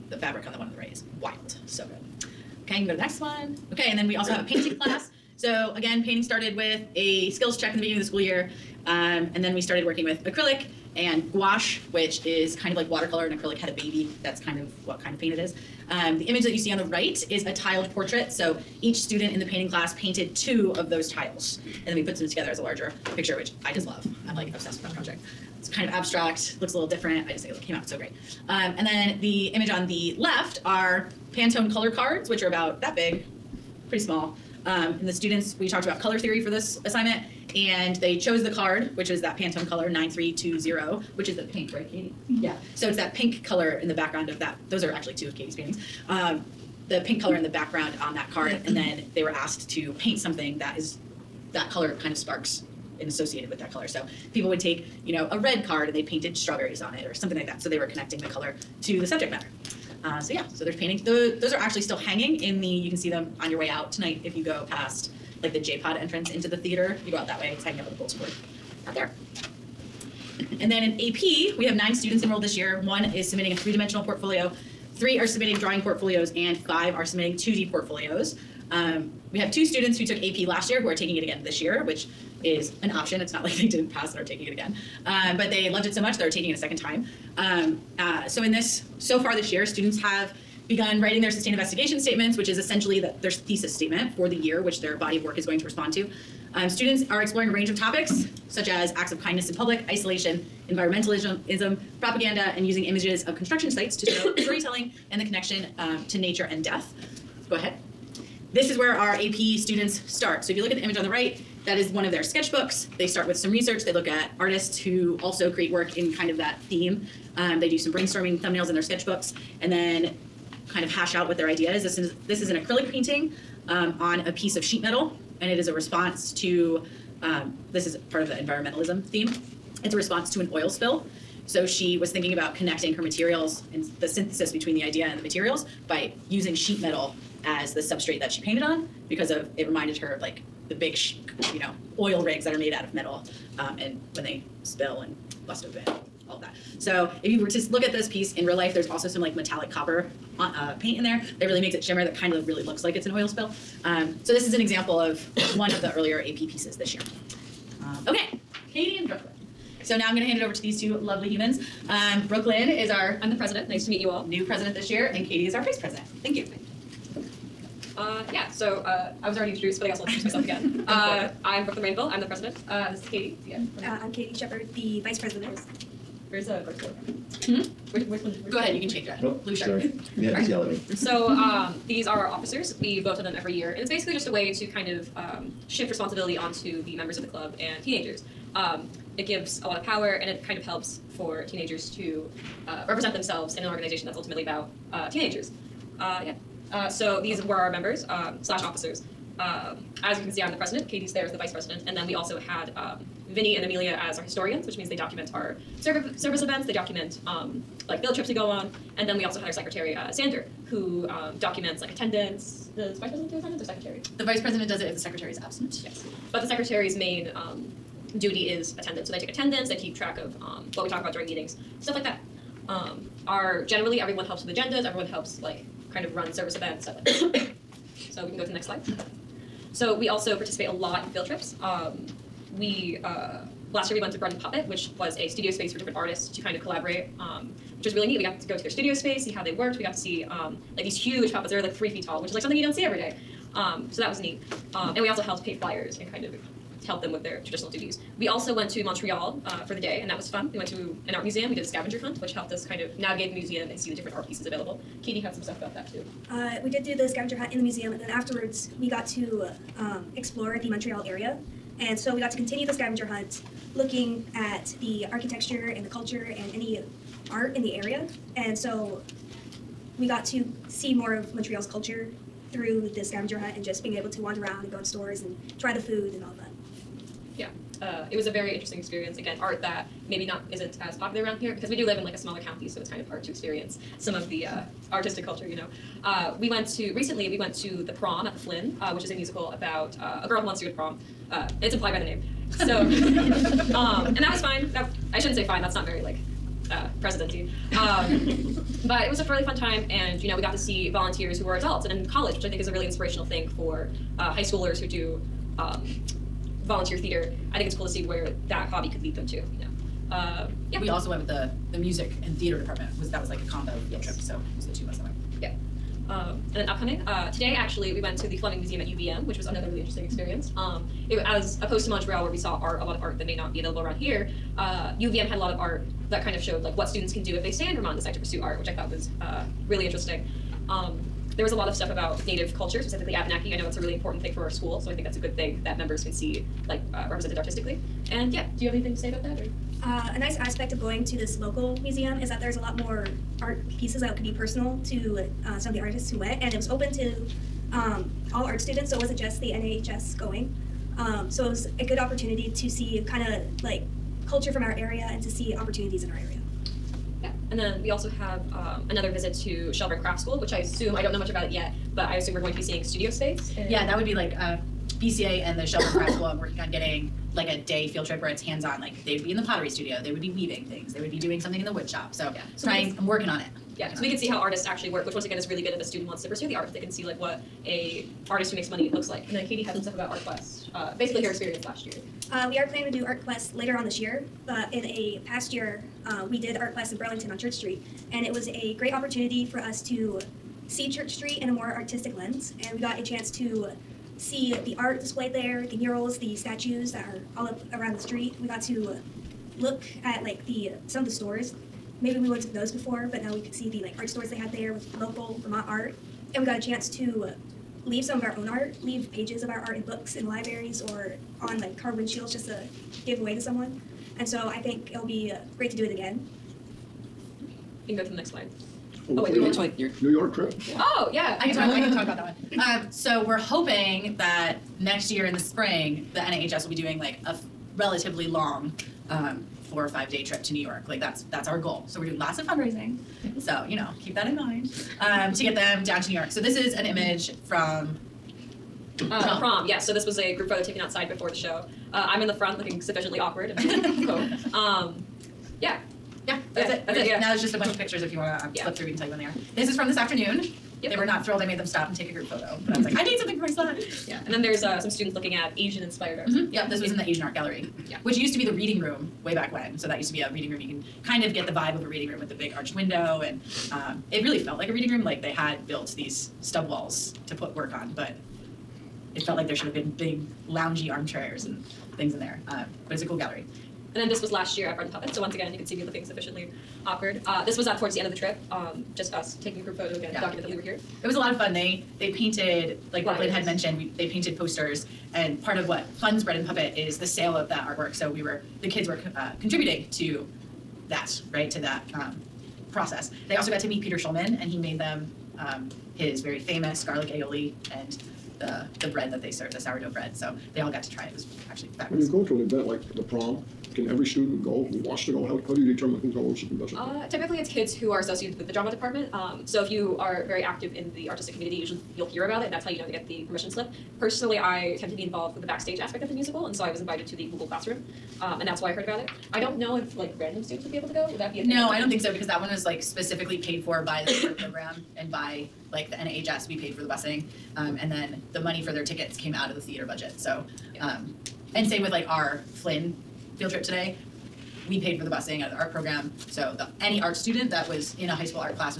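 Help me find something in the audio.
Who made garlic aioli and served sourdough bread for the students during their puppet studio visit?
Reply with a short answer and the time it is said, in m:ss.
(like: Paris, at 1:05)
Peter Schumann, at 8:13.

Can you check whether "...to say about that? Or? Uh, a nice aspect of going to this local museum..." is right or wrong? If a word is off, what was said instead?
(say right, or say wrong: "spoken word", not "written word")
right.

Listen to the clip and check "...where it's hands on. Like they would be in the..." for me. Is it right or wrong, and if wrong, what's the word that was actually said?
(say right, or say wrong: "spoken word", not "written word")
right.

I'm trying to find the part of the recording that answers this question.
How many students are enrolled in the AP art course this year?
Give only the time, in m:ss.
1:11.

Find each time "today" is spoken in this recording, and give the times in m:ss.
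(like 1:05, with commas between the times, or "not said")
5:17, 8:53.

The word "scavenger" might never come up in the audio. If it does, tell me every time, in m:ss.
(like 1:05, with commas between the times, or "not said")
4:11, 4:17, 4:22, 4:33.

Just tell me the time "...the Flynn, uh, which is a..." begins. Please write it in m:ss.
4:48.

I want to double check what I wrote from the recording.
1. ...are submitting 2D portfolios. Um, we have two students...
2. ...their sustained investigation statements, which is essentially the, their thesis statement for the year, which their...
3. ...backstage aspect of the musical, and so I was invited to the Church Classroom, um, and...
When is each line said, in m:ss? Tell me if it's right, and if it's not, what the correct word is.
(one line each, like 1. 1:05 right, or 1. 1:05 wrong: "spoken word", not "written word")
1. 1:16 right
2. 1:31 right
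3. 8:35 wrong: "Google", not "Church".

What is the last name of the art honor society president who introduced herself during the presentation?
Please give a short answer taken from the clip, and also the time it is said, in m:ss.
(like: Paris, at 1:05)
Rainville, at 2:51.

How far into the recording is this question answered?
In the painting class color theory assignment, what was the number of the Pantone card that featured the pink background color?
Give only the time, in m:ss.
0:39.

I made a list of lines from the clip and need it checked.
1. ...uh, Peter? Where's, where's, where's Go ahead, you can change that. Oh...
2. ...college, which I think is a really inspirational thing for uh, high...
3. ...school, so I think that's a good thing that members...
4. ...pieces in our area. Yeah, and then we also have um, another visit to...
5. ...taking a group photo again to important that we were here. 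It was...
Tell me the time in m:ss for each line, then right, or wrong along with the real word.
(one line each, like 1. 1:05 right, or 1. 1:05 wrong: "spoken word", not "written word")
1. 2:56 wrong: "Hmm", not "Peter"
2. 5:02 right
3. 5:34 right
4. 5:55 wrong: "opportunities", not "pieces"
5. 7:59 wrong: "document", not "important".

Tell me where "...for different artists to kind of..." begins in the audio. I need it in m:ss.
3:55.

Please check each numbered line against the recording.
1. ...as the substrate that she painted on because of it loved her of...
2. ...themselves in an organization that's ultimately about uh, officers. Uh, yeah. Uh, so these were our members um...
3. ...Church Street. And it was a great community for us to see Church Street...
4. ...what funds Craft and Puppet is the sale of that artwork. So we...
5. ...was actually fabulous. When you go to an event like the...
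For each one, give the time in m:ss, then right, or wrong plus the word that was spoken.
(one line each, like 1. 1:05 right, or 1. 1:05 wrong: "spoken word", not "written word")
1. 2:17 wrong: "reminded", not "loved"
2. 3:13 wrong: "teenagers", not "officers"
3. 6:27 wrong: "opportunity", not "community"
4. 8:05 wrong: "Bread", not "Craft"
5. 8:21 right.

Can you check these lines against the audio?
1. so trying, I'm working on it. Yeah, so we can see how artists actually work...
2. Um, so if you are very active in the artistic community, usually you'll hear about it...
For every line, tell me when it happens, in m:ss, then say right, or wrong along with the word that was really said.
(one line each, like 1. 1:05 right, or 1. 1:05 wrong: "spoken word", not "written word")
1. 6:12 right
2. 8:29 right.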